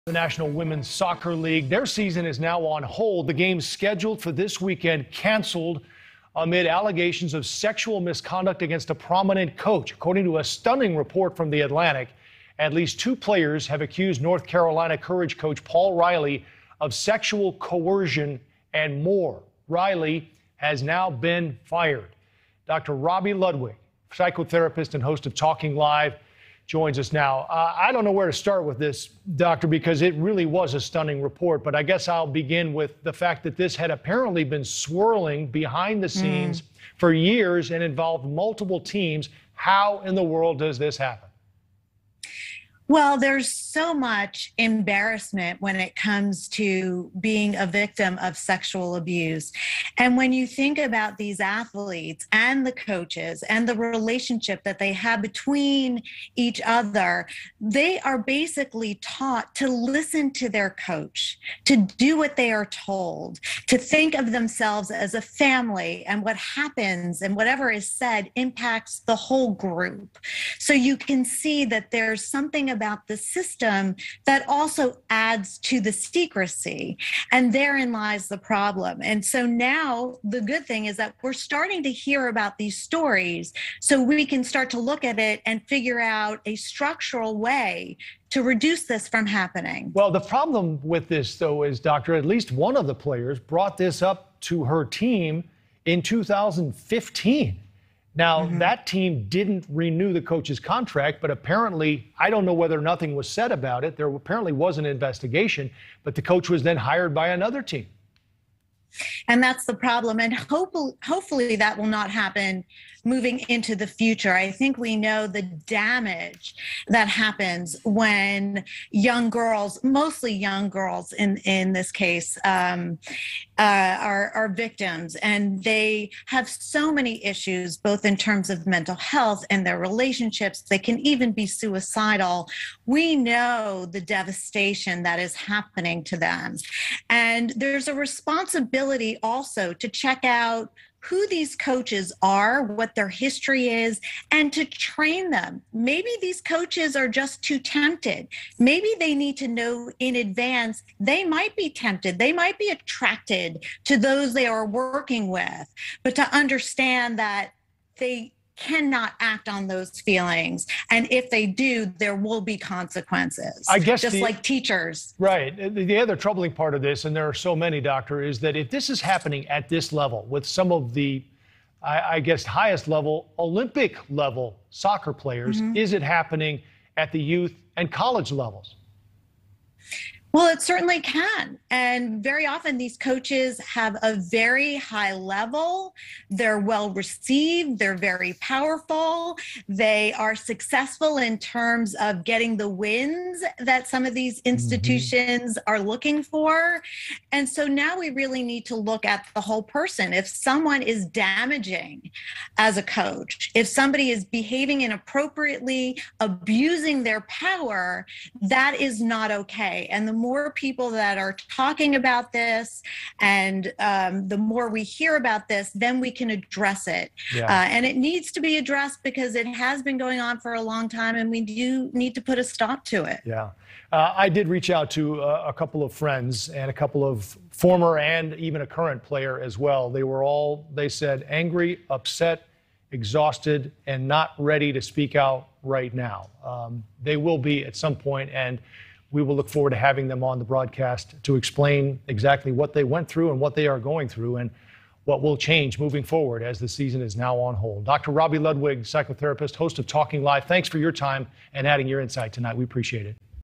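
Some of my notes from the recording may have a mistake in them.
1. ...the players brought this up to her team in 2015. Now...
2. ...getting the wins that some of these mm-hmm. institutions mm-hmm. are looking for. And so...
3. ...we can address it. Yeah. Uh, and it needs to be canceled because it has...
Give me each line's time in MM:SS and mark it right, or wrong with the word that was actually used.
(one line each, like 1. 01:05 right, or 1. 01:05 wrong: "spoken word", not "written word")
1. 01:32 right
2. 03:12 right
3. 03:35 wrong: "addressed", not "canceled".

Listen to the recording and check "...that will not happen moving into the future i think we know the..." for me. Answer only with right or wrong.
right.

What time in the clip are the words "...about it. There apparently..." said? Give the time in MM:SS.
01:43.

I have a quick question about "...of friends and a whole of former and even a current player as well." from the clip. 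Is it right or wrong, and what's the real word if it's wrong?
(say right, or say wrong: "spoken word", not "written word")
wrong: "couple", not "whole".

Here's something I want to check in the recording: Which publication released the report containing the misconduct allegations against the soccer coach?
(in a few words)
The Atlantic.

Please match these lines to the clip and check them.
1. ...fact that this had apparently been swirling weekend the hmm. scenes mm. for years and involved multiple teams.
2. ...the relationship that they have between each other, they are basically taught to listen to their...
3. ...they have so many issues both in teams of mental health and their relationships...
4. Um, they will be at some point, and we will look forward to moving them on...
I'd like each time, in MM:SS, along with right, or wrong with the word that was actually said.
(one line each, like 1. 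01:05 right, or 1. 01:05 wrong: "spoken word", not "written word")
1. 00:33 wrong: "behind", not "weekend"
2. 00:53 right
3. 02:05 wrong: "terms", not "teams"
4. 03:56 wrong: "having", not "moving".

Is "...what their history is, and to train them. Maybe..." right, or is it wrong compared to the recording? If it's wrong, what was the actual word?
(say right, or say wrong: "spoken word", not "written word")
right.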